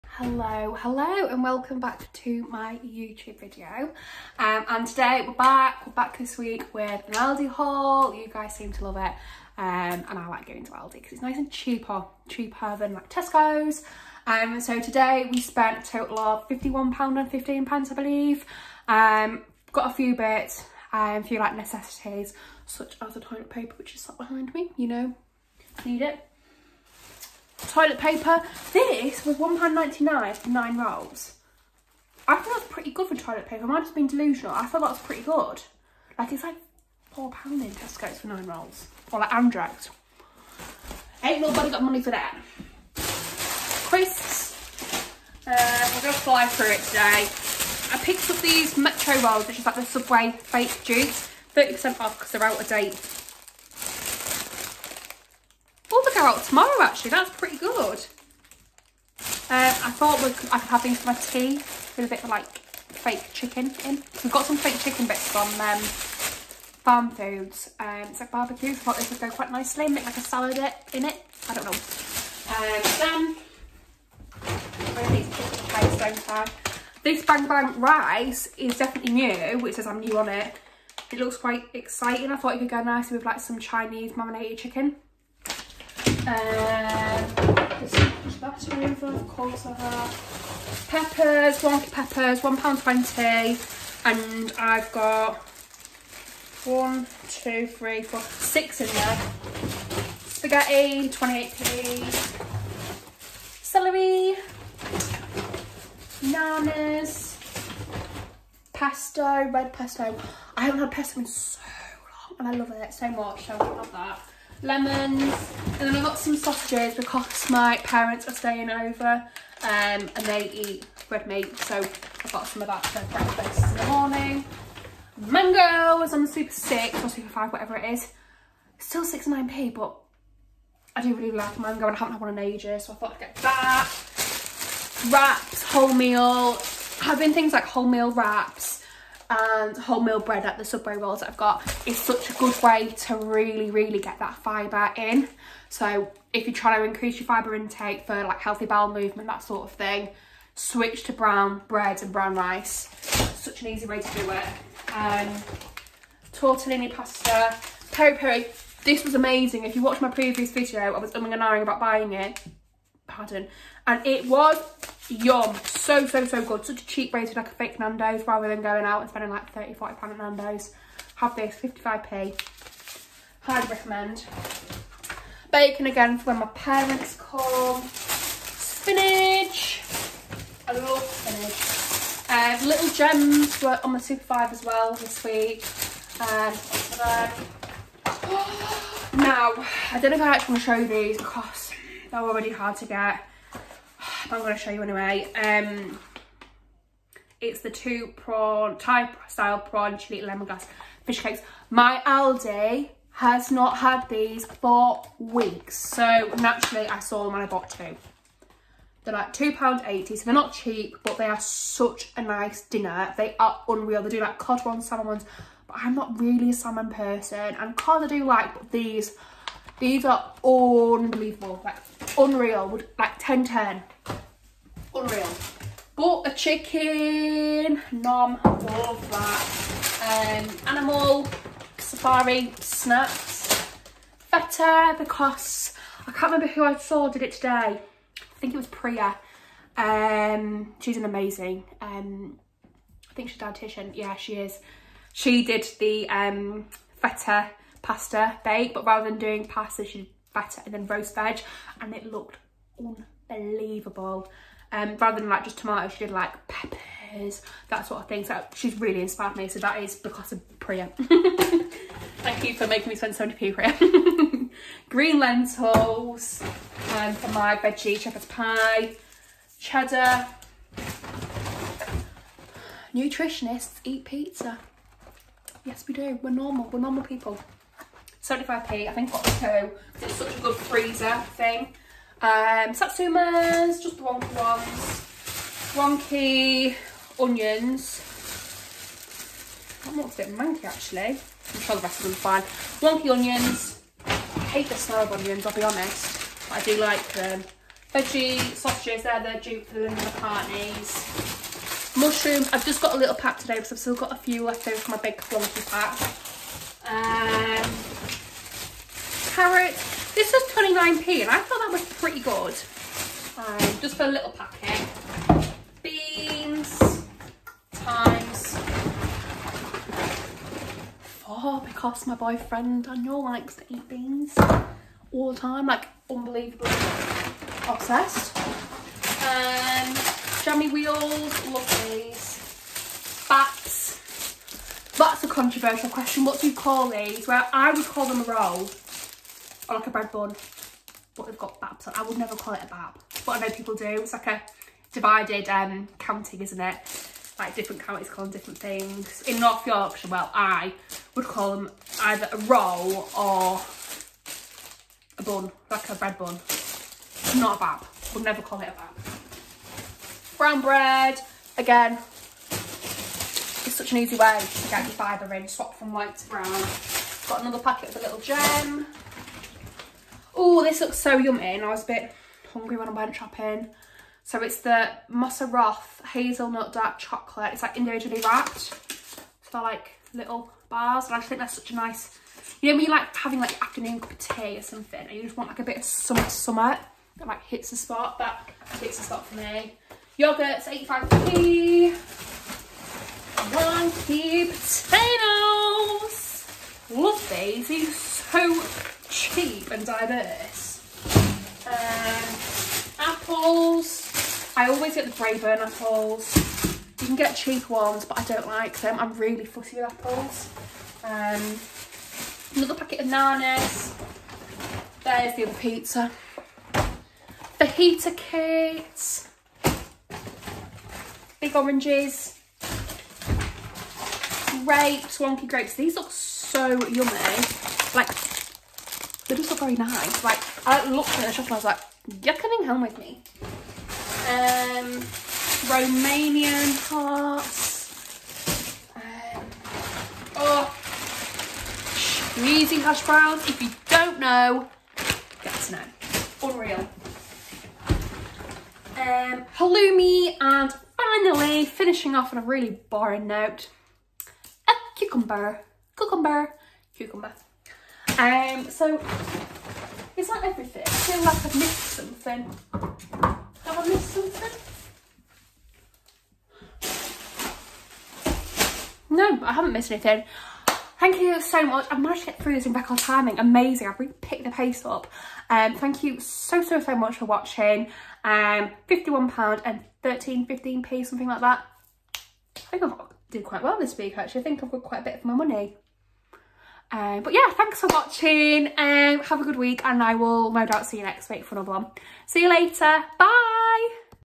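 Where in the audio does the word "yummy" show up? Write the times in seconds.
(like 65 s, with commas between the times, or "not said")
371 s, 426 s.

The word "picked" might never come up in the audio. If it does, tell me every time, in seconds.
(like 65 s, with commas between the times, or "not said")
48 s, 474 s.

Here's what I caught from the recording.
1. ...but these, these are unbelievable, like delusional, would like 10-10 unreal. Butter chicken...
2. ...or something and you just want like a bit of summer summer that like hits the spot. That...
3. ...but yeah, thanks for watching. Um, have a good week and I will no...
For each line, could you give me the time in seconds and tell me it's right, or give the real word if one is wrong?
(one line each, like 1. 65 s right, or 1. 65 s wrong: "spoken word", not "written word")
1. 218 s wrong: "unreal", not "delusional"
2. 384 s right
3. 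487 s right.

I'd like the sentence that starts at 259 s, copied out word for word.
So that is because of Priya.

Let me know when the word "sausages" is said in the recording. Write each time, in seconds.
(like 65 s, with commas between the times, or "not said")
116 s, 298 s.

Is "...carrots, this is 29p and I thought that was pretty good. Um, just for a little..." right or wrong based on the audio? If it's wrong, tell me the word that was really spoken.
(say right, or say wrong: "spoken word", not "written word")
right.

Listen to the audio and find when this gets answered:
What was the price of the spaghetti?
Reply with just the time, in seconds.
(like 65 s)
101 s.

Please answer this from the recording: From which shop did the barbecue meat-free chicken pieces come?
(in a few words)
Farm Foods.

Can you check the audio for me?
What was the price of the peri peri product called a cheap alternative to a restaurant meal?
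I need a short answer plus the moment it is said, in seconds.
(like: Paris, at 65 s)
55p, at 171 s.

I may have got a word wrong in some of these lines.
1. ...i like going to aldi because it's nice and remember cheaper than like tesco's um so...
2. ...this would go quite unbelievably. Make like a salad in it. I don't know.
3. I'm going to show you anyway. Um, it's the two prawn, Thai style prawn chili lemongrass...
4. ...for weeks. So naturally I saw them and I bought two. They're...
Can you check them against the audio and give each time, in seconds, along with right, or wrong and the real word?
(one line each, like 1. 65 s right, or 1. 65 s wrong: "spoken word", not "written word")
1. 10 s wrong: "cheaper", not "remember"
2. 68 s wrong: "nicely", not "unbelievably"
3. 194 s right
4. 204 s right.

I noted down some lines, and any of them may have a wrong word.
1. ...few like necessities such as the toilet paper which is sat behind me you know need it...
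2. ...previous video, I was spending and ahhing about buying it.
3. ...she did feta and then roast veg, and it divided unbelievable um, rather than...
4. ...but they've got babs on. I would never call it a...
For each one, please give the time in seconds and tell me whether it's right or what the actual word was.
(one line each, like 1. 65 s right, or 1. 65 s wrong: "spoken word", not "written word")
1. 21 s right
2. 160 s wrong: "umming", not "spending"
3. 249 s wrong: "looked", not "divided"
4. 341 s right.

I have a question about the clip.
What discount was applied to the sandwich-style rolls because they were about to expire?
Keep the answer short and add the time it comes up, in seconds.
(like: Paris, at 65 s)
30% off, at 51 s.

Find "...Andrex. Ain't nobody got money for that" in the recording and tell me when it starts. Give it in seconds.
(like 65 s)
39 s.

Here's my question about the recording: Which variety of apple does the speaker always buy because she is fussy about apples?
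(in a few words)
Braeburn.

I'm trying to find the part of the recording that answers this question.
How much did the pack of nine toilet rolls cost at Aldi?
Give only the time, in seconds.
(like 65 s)
29 s.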